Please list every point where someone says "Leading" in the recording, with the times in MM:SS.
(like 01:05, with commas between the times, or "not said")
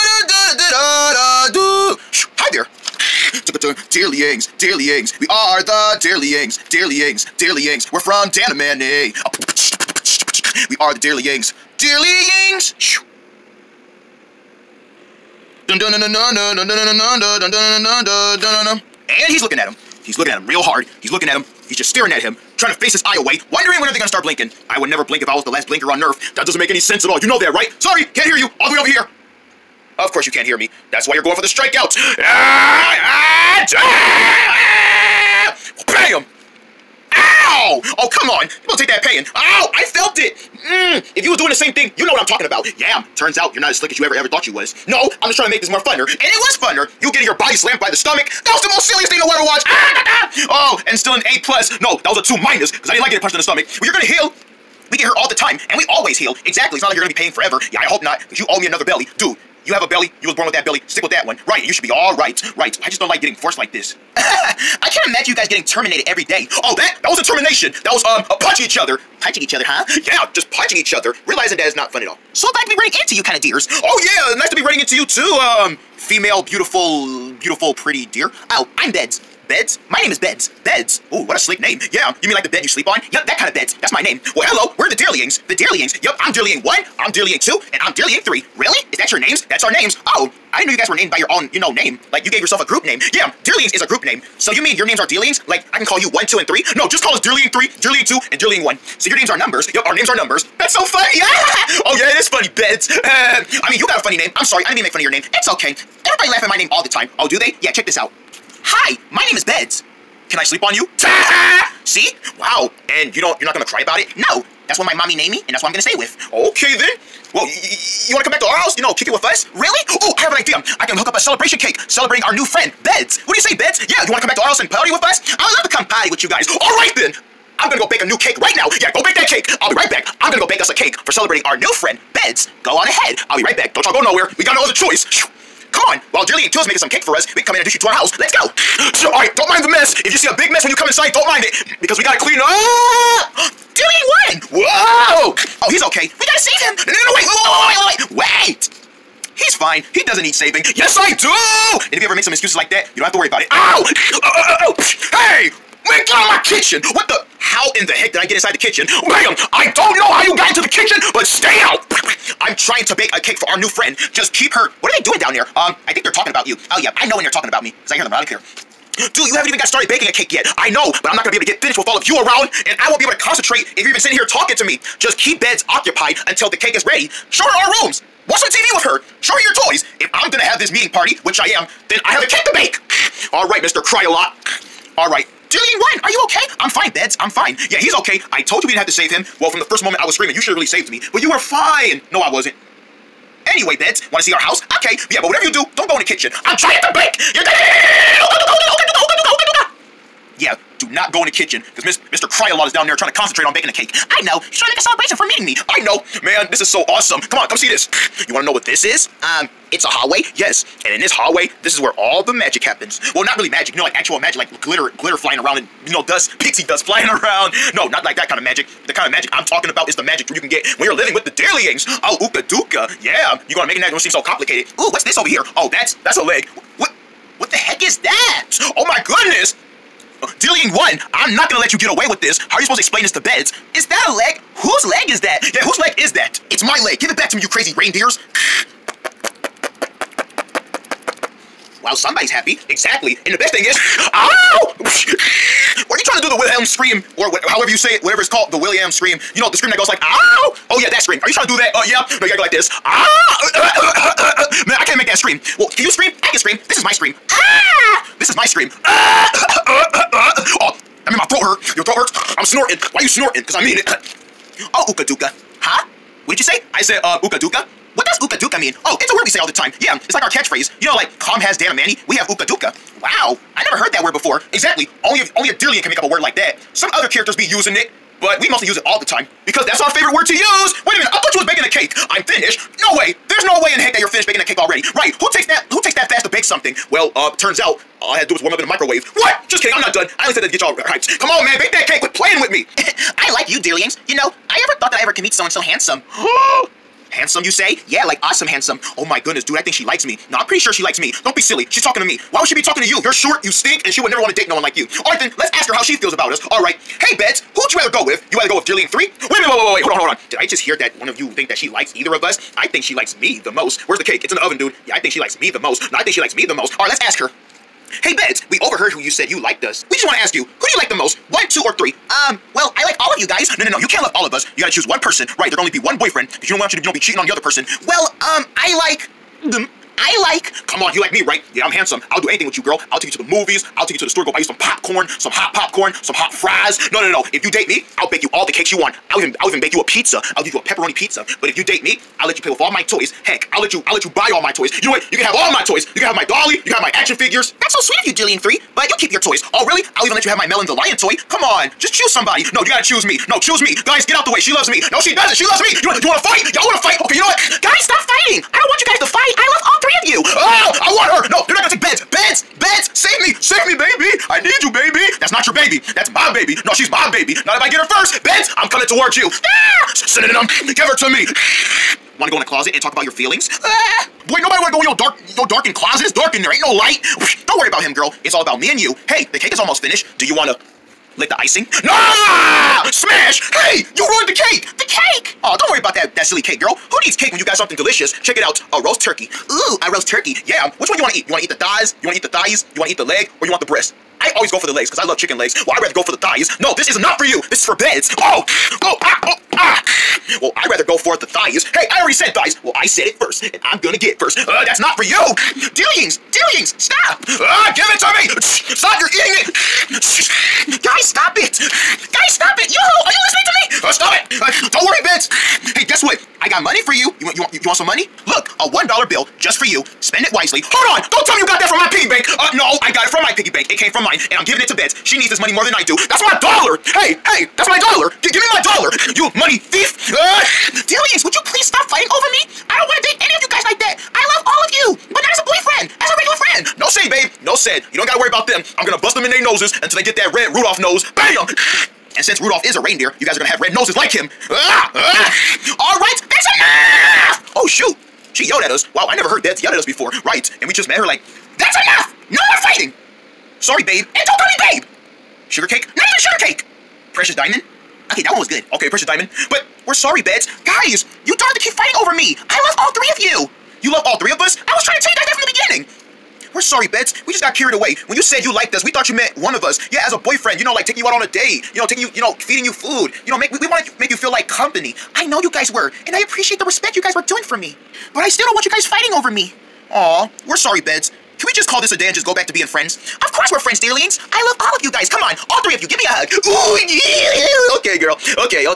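05:08.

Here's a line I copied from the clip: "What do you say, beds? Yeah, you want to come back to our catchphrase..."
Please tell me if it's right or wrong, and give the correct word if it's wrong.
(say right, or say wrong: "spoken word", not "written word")
wrong: "house", not "catchphrase".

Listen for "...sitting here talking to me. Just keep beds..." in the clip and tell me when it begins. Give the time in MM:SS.
02:53.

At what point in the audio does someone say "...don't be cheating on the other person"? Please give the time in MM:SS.
05:26.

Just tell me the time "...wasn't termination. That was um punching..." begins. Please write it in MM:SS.
01:07.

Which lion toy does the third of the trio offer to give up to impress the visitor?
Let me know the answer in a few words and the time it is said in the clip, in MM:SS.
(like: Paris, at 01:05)
Melon the Lion, at 05:50.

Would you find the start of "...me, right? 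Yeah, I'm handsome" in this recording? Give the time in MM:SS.
05:31.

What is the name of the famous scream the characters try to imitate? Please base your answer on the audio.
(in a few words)
The William scream.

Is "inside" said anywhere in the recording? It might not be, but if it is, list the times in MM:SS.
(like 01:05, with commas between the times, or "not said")
02:20, 02:38.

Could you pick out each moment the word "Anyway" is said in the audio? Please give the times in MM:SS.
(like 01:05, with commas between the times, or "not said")
03:13.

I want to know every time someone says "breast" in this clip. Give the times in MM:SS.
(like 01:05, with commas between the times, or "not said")
06:33.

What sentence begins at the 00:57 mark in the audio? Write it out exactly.
Yeah, I hope not, because you owe me another belly.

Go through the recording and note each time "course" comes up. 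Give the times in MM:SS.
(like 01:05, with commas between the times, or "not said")
00:30, 08:03.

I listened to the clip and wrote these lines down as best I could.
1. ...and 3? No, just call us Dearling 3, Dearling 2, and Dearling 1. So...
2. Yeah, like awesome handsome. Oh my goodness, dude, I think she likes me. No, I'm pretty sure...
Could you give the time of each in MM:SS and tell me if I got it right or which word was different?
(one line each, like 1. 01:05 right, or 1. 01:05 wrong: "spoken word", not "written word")
1. 01:36 right
2. 04:57 right.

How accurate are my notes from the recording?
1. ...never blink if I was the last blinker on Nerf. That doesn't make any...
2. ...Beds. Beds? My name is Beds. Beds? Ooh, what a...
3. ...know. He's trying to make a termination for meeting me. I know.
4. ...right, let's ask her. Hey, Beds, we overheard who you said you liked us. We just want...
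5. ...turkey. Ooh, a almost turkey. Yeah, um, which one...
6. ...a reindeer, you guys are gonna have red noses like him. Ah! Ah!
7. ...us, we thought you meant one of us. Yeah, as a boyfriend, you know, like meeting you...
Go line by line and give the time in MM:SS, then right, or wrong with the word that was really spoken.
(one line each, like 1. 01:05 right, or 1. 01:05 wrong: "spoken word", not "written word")
1. 00:24 right
2. 01:18 right
3. 03:24 wrong: "celebration", not "termination"
4. 05:16 right
5. 06:29 wrong: "roast", not "almost"
6. 07:22 right
7. 07:48 wrong: "taking", not "meeting".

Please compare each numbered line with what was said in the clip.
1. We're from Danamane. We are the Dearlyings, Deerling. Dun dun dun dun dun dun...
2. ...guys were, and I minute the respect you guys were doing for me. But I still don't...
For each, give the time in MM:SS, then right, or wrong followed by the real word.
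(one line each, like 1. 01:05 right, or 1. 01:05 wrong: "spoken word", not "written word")
1. 00:07 wrong: "Dearlyings", not "Deerling"
2. 07:55 wrong: "appreciate", not "minute".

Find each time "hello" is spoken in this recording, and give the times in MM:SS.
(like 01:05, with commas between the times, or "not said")
01:24.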